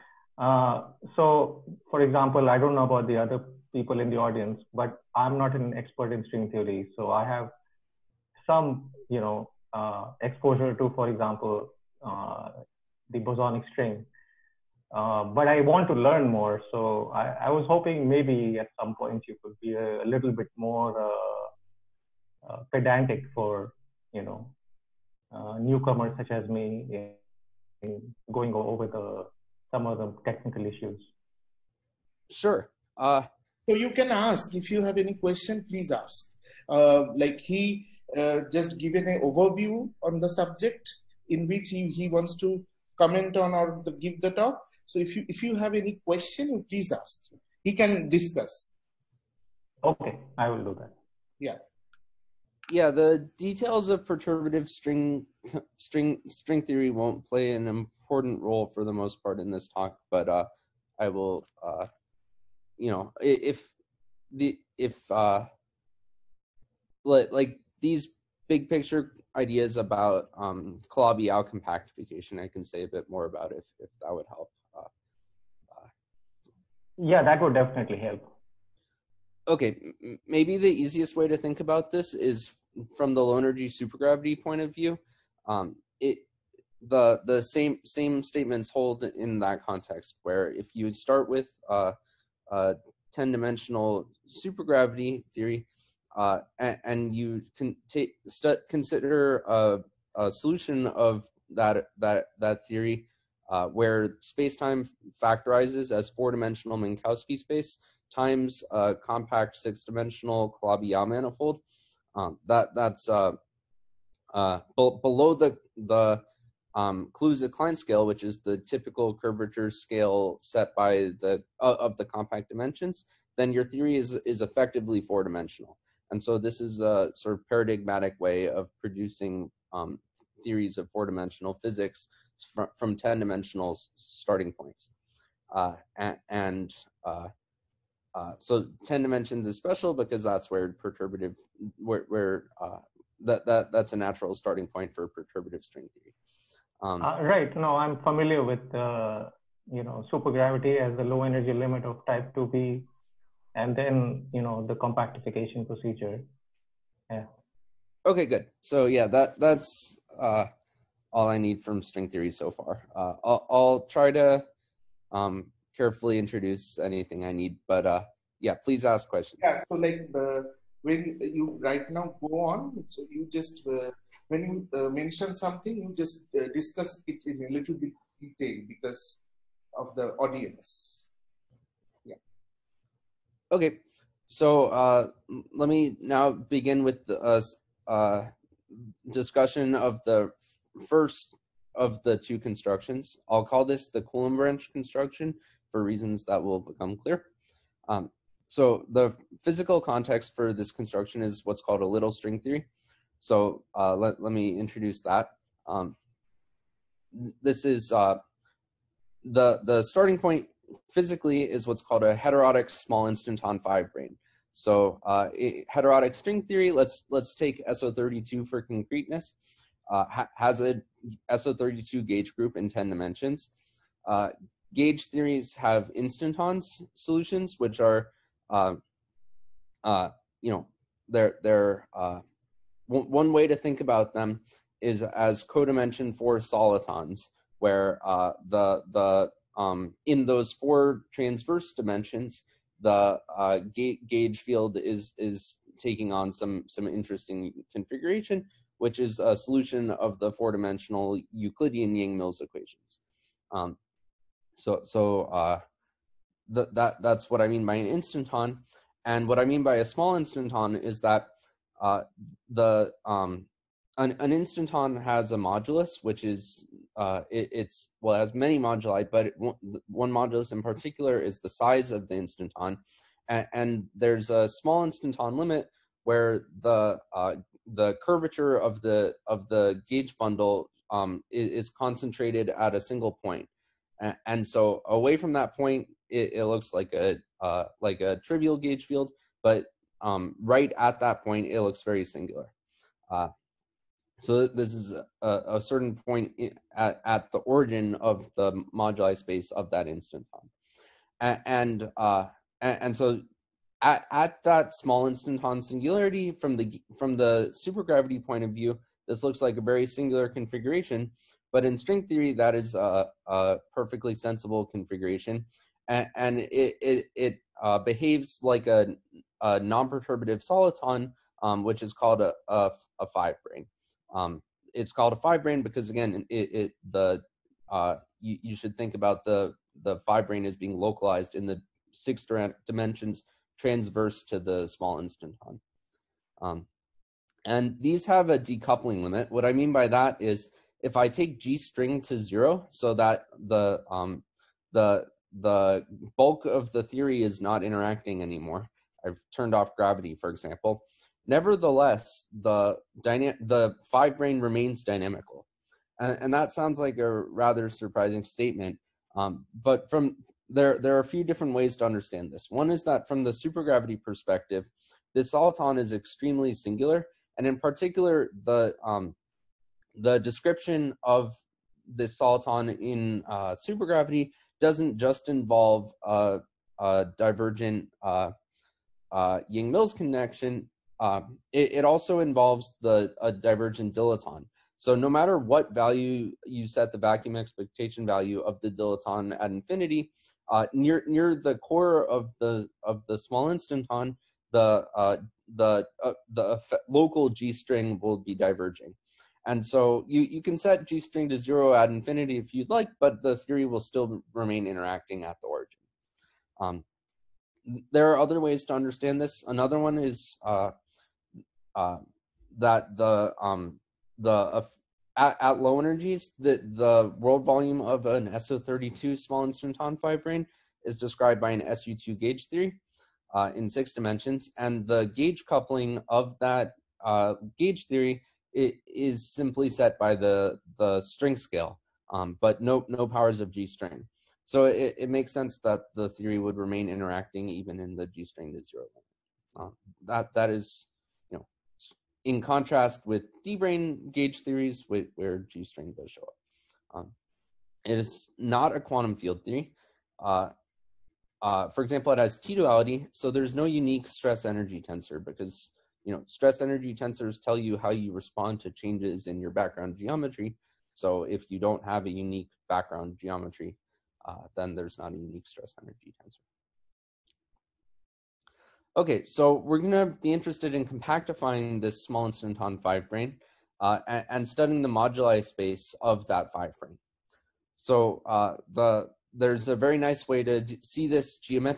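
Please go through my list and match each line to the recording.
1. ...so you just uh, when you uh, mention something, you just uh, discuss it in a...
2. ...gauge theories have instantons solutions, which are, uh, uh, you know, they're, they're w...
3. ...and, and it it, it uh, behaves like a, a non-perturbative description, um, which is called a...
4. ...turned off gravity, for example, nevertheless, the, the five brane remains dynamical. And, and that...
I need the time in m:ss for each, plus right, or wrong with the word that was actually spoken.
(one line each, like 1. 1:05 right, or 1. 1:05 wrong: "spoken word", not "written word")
1. 2:52 right
2. 3:44 right
3. 5:15 wrong: "soliton", not "description"
4. 5:49 right.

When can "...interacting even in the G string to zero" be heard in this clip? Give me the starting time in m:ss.
7:16.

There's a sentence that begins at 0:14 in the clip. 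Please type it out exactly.
Uh, but I want to learn more.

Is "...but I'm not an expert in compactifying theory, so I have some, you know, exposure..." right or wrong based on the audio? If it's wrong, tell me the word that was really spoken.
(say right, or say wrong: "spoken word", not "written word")
wrong: "string", not "compactifying".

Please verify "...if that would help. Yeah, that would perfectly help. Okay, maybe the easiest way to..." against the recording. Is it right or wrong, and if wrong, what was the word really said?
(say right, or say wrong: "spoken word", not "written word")
wrong: "definitely", not "perfectly".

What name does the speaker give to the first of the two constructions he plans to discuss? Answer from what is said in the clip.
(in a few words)
Coulomb branch construction.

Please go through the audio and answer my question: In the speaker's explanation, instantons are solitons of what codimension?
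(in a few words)
4.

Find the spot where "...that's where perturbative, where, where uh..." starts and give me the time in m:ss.
2:20.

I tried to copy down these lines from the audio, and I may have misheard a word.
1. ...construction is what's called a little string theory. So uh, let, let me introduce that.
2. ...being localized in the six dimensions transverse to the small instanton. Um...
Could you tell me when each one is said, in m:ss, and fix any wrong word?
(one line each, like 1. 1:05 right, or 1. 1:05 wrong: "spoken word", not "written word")
1. 3:20 right
2. 5:30 right.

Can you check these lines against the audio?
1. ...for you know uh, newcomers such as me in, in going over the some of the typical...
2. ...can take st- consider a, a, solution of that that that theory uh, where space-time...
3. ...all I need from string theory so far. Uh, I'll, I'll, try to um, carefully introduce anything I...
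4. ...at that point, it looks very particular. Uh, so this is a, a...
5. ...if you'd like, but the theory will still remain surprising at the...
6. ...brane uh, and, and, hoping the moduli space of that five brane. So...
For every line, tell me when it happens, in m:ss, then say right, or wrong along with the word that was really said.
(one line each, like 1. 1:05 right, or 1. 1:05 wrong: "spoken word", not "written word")
1. 0:23 wrong: "technical", not "typical"
2. 1:37 right
3. 2:41 right
4. 4:50 wrong: "singular", not "particular"
5. 6:42 wrong: "interacting", not "surprising"
6. 7:53 wrong: "studying", not "hoping".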